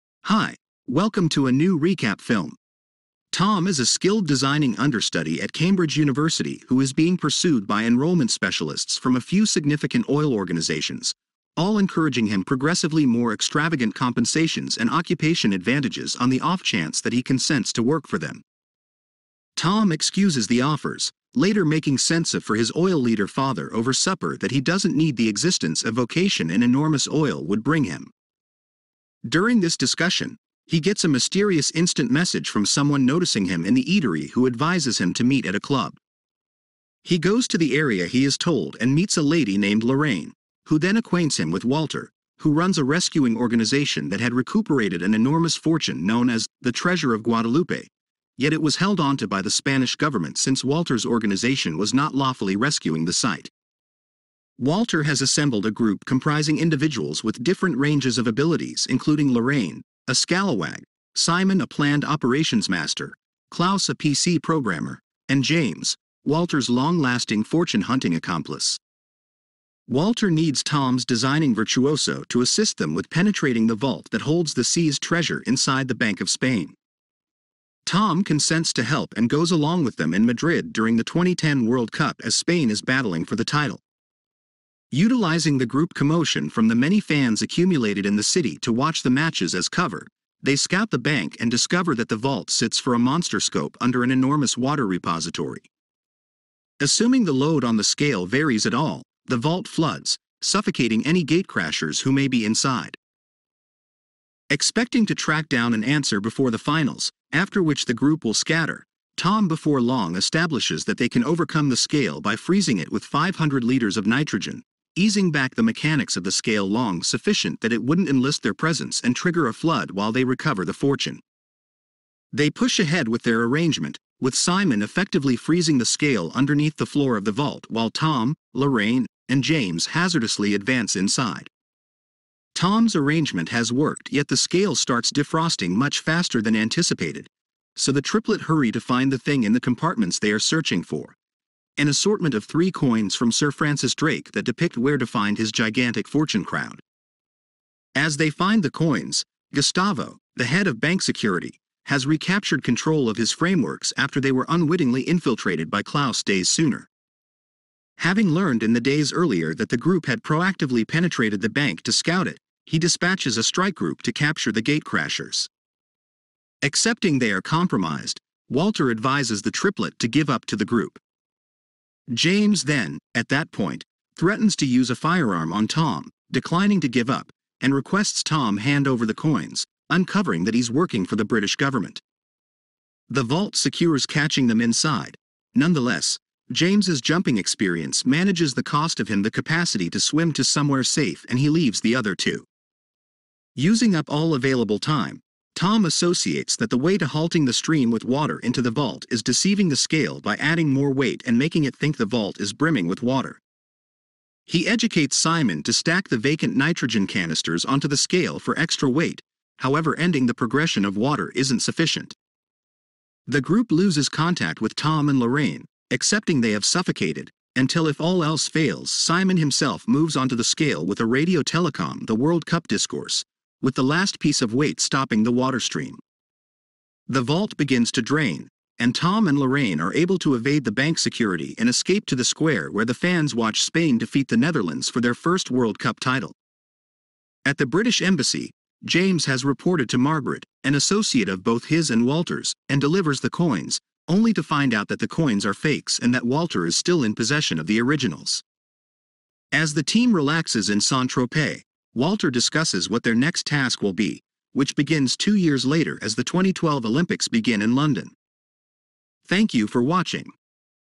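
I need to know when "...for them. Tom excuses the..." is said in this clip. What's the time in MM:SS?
00:18.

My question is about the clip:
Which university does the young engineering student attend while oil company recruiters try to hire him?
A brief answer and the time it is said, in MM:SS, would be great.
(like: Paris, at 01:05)
Cambridge University, at 00:05.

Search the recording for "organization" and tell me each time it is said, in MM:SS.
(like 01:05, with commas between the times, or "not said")
00:10, 00:43, 00:51.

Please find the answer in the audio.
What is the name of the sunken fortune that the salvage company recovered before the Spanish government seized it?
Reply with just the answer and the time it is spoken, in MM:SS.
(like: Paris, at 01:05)
Treasure of Guadalupe, at 00:46.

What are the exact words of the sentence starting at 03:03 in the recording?
The vault secures catching them inside.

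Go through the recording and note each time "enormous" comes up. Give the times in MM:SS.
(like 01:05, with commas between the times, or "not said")
00:26, 00:45, 01:34.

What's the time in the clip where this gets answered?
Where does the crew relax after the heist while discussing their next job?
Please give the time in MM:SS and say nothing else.
04:10.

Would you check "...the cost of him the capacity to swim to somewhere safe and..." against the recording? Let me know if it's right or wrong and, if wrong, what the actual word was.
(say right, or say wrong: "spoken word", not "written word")
right.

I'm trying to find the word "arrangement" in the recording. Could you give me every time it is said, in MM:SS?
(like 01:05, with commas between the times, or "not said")
02:03, 02:12.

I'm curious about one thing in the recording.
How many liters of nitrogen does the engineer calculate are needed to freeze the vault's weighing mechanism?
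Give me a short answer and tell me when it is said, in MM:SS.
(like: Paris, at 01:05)
500, at 01:53.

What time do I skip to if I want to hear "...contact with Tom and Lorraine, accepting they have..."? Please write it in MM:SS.
03:34.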